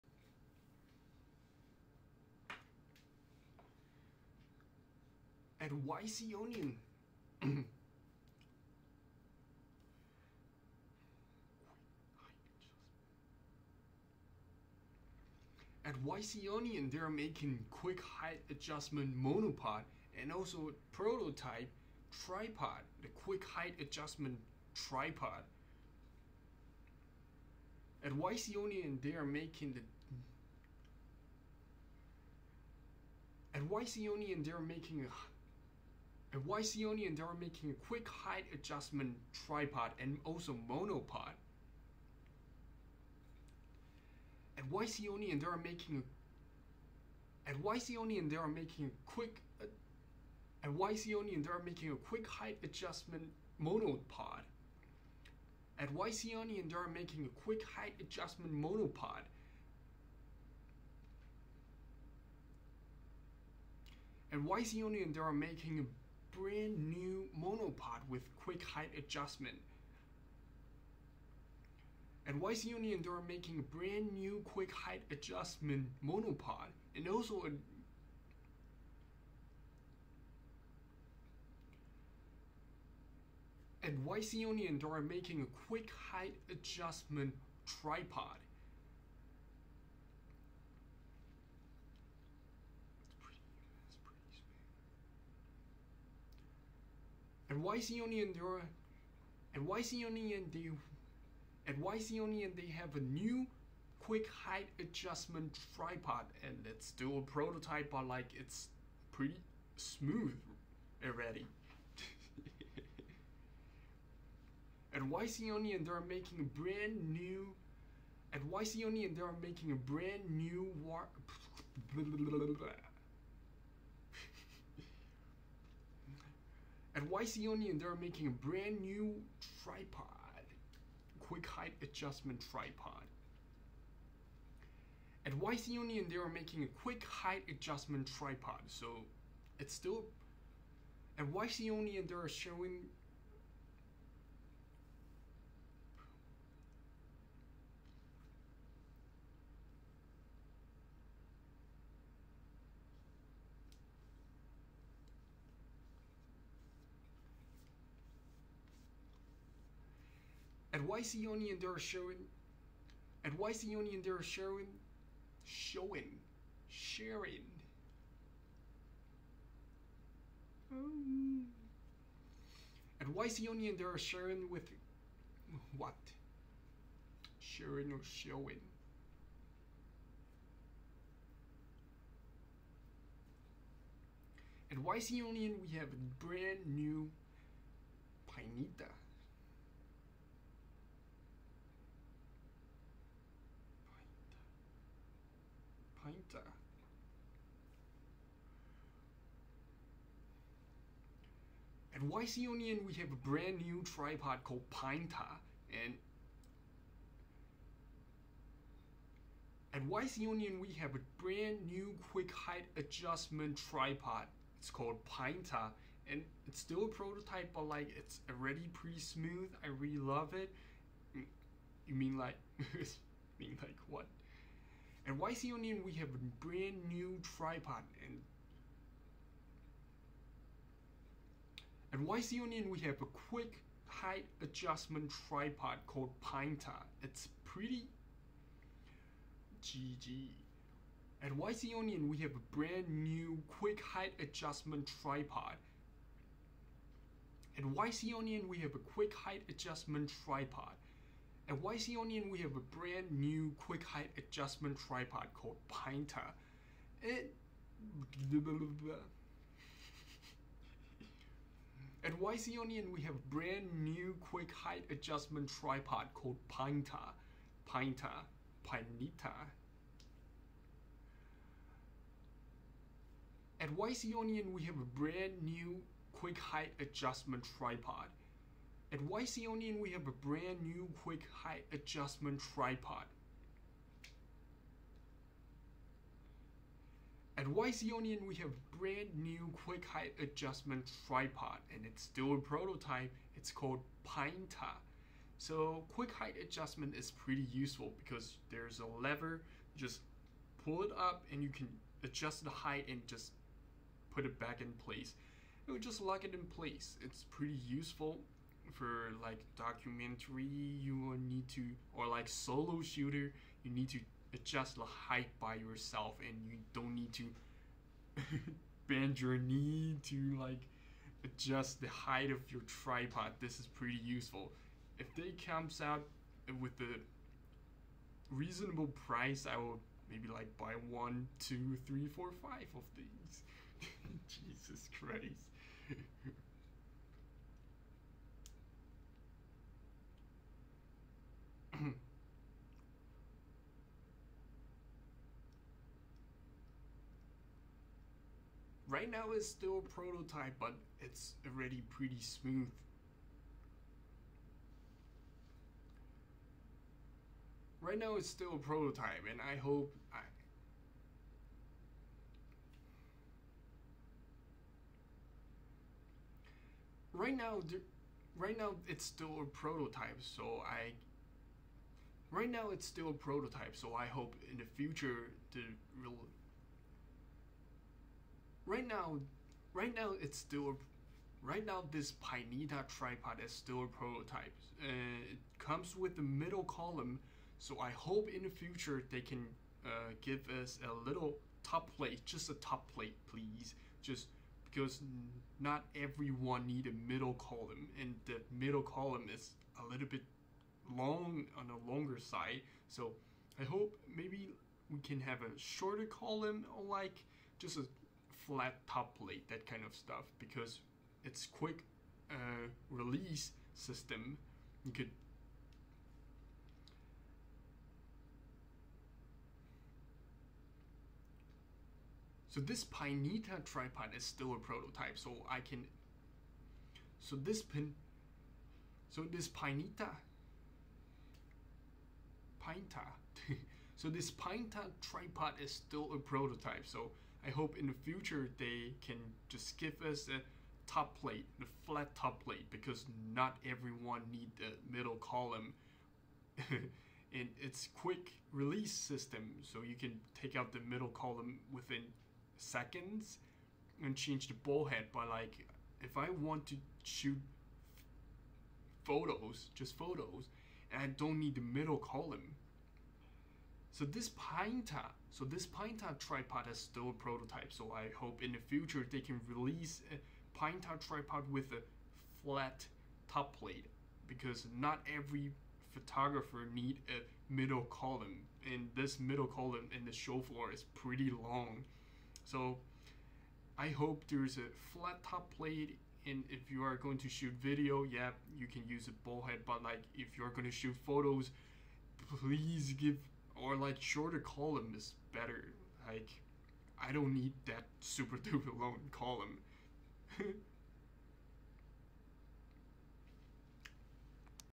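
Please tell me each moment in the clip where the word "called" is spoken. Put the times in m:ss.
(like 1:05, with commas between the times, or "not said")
3:24, 3:34, 3:55, 4:15, 4:26, 4:53.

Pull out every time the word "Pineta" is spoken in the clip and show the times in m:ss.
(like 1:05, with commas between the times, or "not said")
6:22, 7:02, 7:09.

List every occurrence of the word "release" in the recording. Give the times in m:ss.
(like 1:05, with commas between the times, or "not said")
6:52, 7:28, 7:49.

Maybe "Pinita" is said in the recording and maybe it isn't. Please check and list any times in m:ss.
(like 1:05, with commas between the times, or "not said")
3:08, 4:28.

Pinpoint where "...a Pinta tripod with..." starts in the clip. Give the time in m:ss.
7:50.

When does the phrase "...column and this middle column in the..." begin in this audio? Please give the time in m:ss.
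7:57.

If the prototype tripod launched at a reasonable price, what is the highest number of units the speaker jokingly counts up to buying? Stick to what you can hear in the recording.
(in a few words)
5.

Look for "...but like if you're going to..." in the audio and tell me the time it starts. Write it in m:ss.
8:09.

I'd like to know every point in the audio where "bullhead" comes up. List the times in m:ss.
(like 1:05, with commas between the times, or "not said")
7:34, 8:09.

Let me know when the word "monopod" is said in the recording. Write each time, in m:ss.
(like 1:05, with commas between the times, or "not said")
0:19, 0:40, 0:53, 0:58, 1:07, 1:16.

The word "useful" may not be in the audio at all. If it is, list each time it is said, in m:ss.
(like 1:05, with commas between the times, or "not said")
4:57, 5:07, 5:24.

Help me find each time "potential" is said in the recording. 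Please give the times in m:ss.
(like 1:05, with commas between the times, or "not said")
not said.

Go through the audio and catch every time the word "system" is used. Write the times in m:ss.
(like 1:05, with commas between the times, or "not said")
6:53, 7:28.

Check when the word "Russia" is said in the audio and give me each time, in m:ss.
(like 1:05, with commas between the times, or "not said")
not said.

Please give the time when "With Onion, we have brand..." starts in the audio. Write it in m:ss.
4:47.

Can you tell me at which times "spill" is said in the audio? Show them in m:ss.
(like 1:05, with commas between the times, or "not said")
not said.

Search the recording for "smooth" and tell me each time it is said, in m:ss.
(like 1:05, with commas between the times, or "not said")
1:49, 3:38, 5:52.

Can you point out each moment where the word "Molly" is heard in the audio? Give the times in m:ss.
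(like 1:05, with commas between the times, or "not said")
not said.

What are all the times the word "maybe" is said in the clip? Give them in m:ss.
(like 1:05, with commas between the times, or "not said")
5:30, 6:44.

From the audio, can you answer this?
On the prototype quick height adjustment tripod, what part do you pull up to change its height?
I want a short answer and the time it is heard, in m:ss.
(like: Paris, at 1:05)
lever, at 4:58.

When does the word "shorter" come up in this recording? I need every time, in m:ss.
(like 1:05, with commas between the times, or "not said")
6:45, 8:13.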